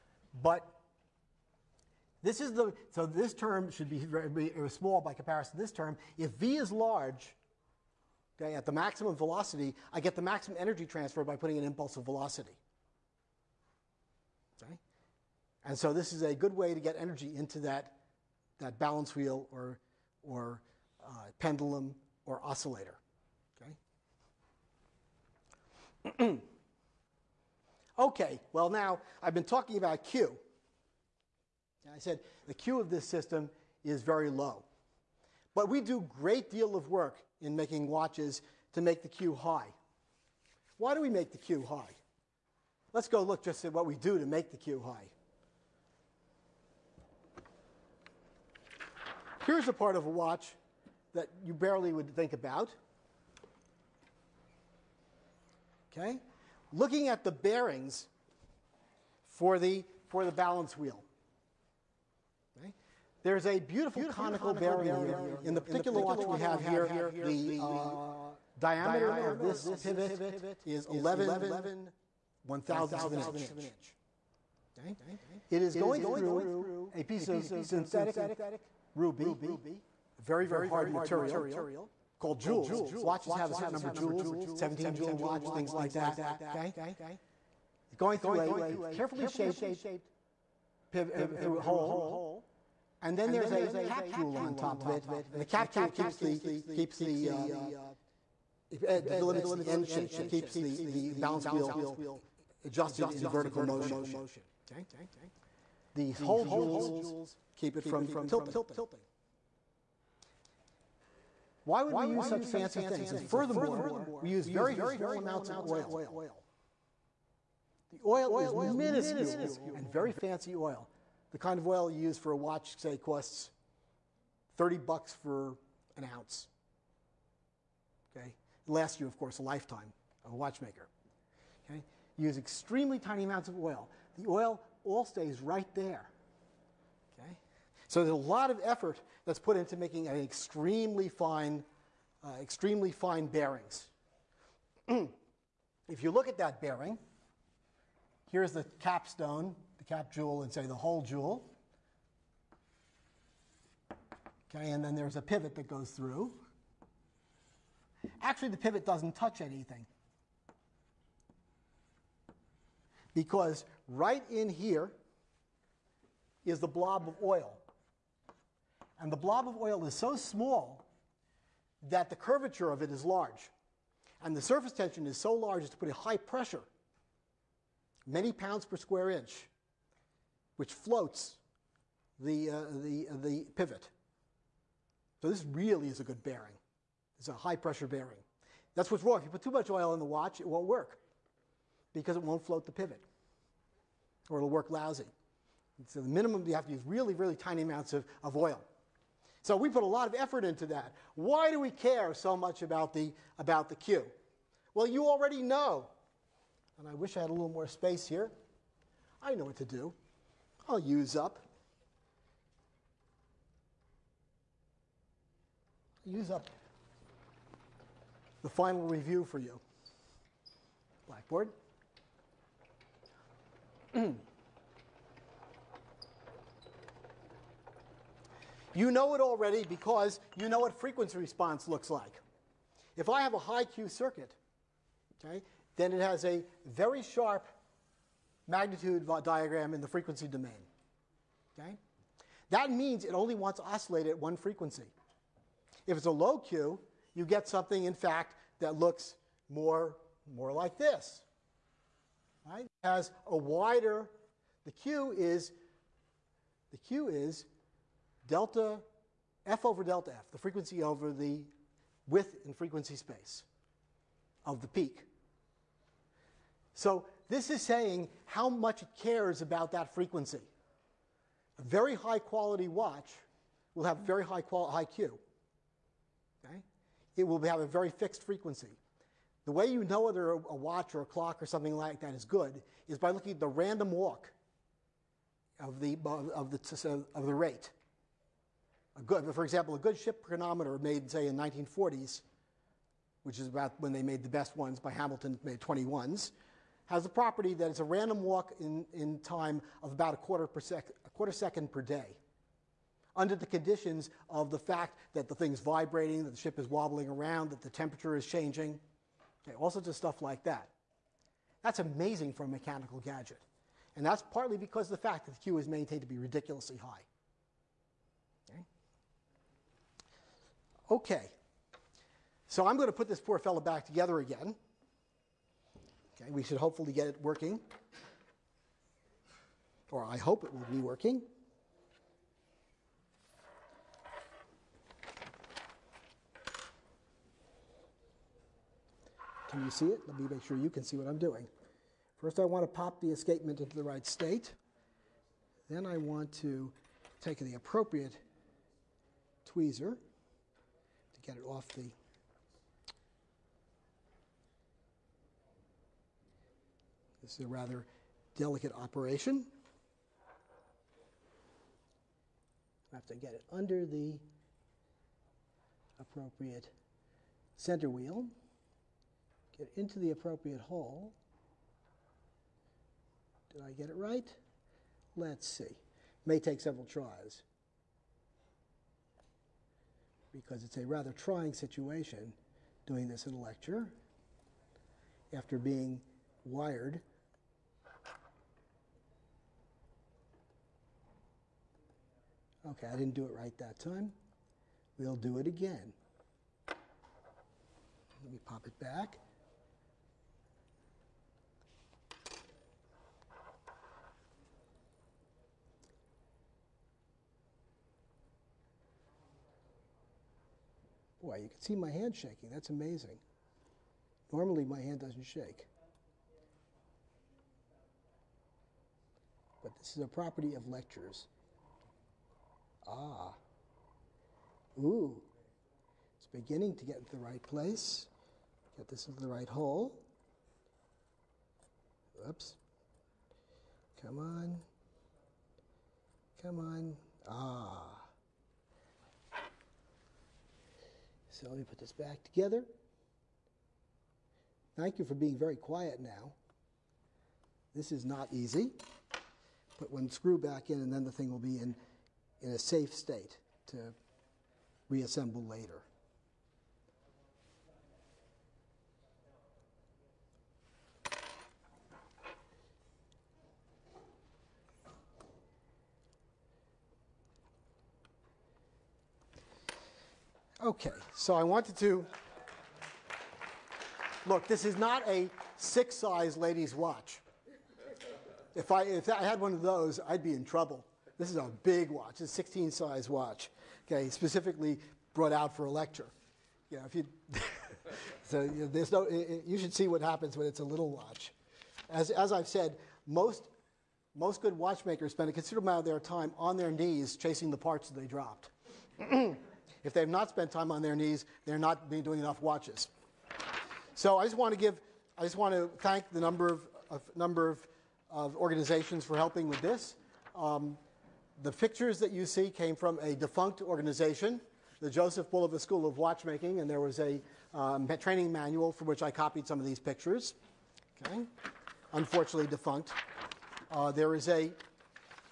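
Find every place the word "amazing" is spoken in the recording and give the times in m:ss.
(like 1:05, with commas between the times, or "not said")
5:11, 6:52.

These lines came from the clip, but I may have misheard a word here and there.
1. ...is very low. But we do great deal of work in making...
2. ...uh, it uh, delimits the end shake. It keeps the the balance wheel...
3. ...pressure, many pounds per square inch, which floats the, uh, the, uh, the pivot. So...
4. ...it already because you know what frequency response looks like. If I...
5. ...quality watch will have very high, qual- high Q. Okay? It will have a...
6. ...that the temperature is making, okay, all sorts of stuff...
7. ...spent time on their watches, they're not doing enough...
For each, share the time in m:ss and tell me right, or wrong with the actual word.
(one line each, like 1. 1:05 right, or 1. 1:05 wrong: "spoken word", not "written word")
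1. 0:33 right
2. 1:37 right
3. 2:56 right
4. 3:49 right
5. 4:32 right
6. 5:07 wrong: "changing", not "making"
7. 8:20 wrong: "knees", not "watches".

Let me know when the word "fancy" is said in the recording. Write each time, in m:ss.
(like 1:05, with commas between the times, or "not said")
1:52, 2:00.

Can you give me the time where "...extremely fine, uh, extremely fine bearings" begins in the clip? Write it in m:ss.
2:20.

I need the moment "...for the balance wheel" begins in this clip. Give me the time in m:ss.
1:00.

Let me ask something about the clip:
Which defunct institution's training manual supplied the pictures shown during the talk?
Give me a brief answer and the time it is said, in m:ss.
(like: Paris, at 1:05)
Joseph Bulova School of Watchmaking, at 8:34.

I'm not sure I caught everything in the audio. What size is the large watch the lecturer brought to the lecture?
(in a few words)
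16 size.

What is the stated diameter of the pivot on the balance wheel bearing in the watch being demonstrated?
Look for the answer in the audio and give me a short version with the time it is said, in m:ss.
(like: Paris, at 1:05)
11 thousandths of an inch, at 1:10.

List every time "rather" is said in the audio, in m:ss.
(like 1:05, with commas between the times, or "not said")
5:57, 6:20.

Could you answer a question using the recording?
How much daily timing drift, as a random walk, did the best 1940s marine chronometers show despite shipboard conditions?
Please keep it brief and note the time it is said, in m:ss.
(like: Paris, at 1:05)
a quarter second per day, at 5:01.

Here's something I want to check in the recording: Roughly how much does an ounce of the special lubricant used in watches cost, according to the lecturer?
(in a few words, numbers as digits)
30 bucks.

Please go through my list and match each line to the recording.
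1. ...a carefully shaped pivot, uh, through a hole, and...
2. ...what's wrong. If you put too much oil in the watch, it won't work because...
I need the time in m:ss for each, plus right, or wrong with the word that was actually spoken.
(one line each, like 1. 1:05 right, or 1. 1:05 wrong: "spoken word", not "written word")
1. 1:28 right
2. 3:08 right.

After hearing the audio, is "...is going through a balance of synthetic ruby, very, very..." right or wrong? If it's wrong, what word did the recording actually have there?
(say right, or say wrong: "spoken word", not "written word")
wrong: "piece", not "balance".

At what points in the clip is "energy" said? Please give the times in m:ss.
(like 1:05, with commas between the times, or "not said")
0:10, 0:16.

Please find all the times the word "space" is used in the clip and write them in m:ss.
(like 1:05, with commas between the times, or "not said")
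3:27, 4:22.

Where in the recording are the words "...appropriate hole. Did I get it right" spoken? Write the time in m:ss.
6:10.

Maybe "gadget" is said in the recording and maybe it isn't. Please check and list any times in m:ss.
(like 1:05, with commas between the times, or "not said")
5:13.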